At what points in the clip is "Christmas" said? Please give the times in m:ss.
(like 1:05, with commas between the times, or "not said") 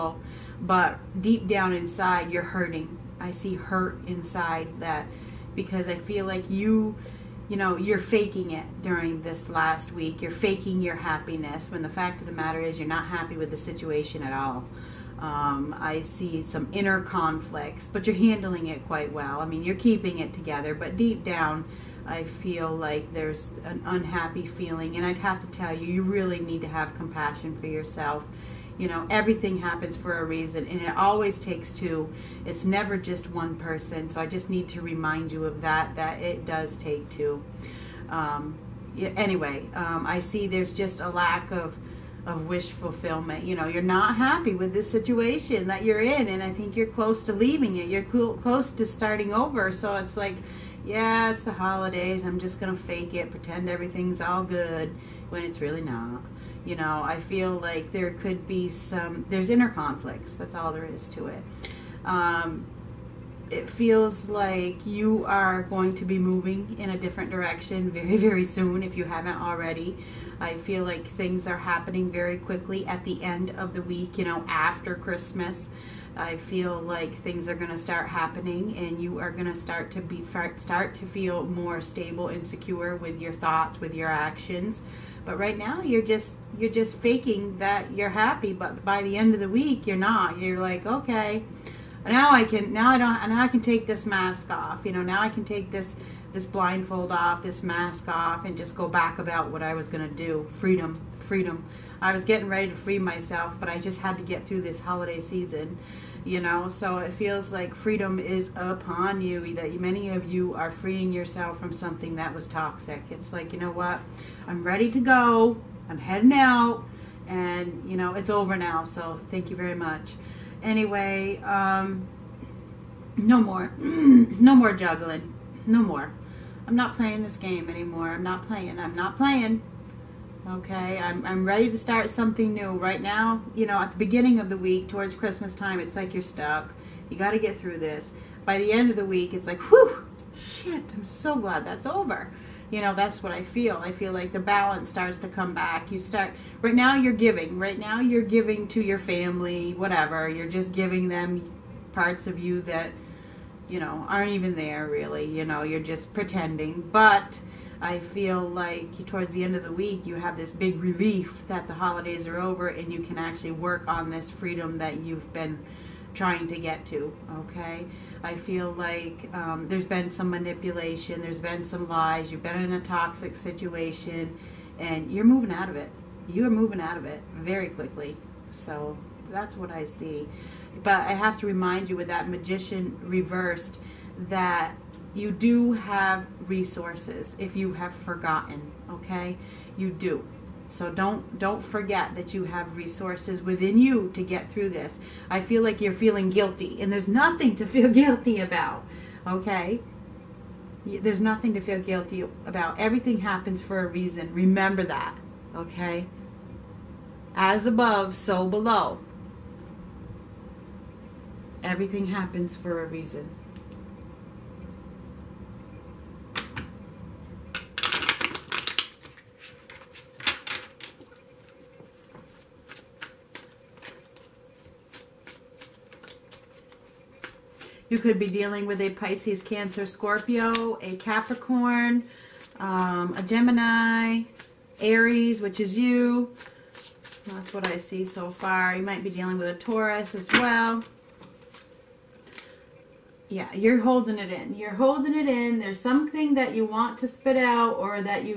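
1:14, 2:15.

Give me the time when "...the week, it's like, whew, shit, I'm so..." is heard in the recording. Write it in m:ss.
2:18.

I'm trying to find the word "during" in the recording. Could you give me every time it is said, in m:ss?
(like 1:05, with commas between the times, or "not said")
0:08.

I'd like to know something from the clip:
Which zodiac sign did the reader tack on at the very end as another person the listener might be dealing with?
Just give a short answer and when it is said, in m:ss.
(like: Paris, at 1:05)
Taurus, at 3:59.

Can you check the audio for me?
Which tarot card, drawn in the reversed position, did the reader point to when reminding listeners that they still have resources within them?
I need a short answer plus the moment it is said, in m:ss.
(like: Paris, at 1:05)
Magician, at 3:02.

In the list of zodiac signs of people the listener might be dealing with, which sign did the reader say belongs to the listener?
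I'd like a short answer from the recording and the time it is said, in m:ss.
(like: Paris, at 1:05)
Aries, at 3:54.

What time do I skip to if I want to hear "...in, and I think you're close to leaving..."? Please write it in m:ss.
0:45.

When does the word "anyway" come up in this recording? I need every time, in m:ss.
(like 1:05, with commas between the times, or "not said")
0:39, 2:00.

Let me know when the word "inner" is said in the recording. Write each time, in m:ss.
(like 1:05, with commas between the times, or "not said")
0:16, 0:59.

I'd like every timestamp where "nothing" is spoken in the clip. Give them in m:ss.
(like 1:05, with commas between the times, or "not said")
3:17, 3:21.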